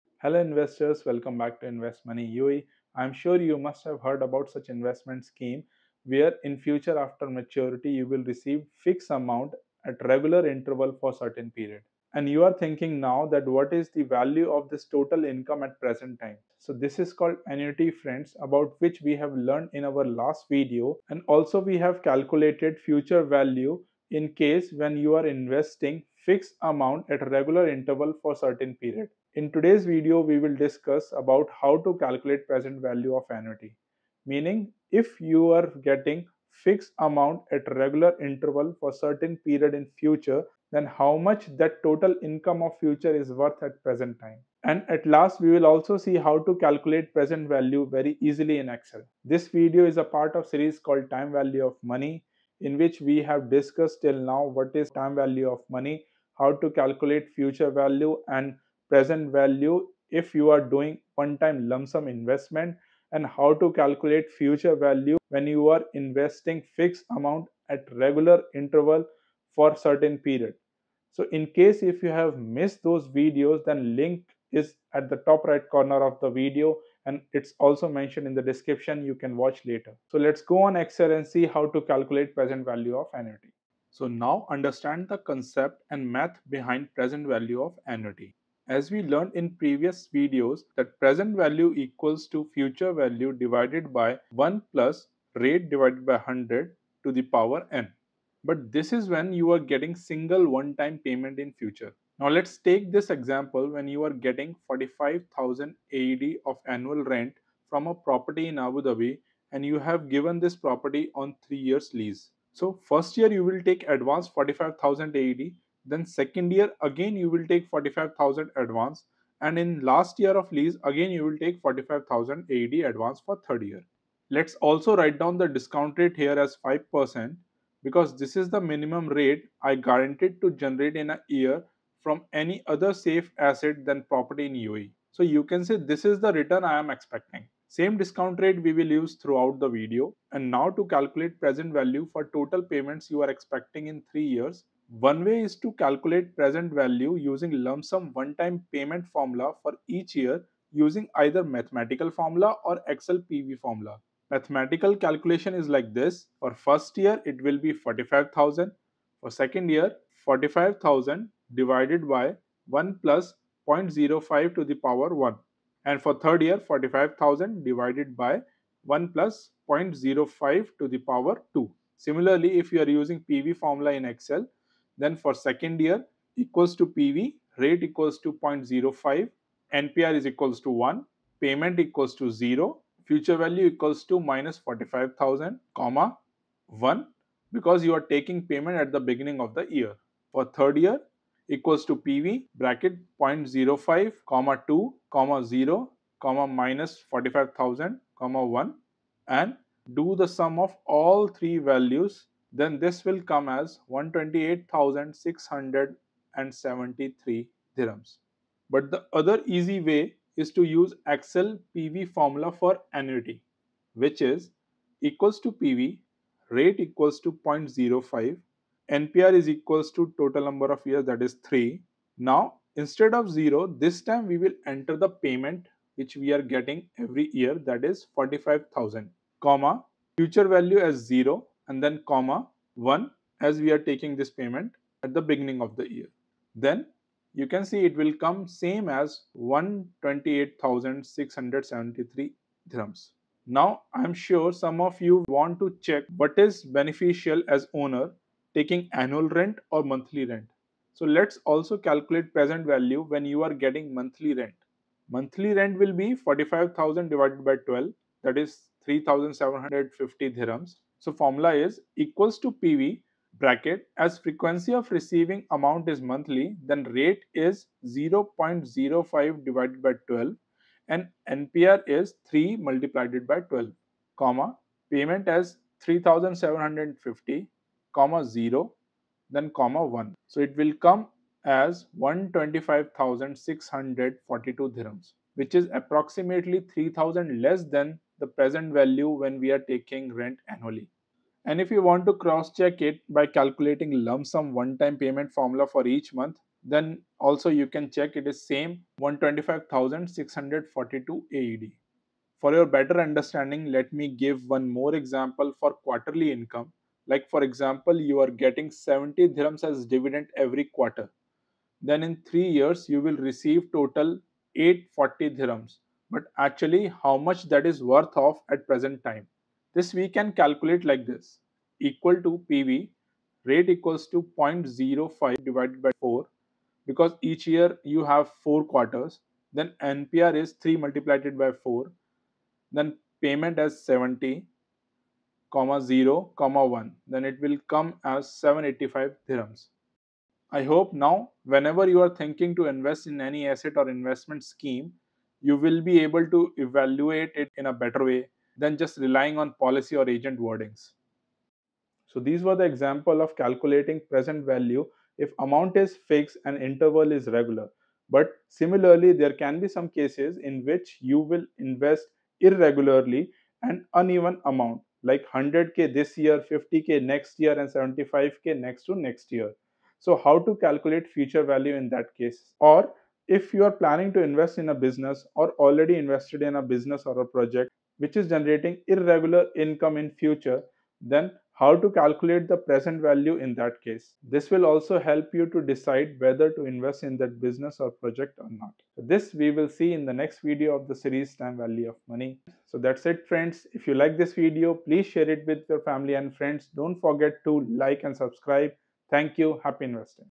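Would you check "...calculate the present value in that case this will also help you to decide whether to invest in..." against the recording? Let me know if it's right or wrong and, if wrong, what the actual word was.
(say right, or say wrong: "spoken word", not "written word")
right.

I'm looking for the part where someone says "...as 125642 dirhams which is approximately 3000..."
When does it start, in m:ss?
4:41.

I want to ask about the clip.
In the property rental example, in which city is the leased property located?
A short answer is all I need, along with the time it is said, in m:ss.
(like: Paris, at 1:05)
Abu Dhabi, at 1:48.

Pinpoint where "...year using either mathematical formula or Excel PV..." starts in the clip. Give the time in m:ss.
2:30.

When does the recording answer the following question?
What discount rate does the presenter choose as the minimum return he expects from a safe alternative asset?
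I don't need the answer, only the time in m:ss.
2:06.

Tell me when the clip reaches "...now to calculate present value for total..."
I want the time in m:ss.
2:20.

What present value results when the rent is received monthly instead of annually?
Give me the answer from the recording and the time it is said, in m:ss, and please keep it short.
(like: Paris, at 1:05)
125,642 AED, at 4:58.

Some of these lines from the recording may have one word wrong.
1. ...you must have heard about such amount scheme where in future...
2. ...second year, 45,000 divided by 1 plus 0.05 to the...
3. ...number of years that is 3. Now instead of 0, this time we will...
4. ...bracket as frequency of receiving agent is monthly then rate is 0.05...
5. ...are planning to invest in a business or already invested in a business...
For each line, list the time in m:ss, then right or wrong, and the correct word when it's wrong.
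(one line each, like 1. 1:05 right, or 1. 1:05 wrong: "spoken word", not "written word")
1. 0:03 wrong: "investment", not "amount"
2. 2:39 right
3. 3:40 right
4. 4:23 wrong: "amount", not "agent"
5. 6:13 right.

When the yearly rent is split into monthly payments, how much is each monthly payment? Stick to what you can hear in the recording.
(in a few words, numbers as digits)
3750 dirhams.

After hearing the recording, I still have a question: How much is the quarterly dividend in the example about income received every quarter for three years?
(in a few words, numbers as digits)
70 dirhams.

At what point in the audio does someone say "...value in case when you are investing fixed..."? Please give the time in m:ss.
0:23.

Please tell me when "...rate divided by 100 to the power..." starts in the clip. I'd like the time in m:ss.
1:35.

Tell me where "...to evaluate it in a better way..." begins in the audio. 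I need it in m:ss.
5:46.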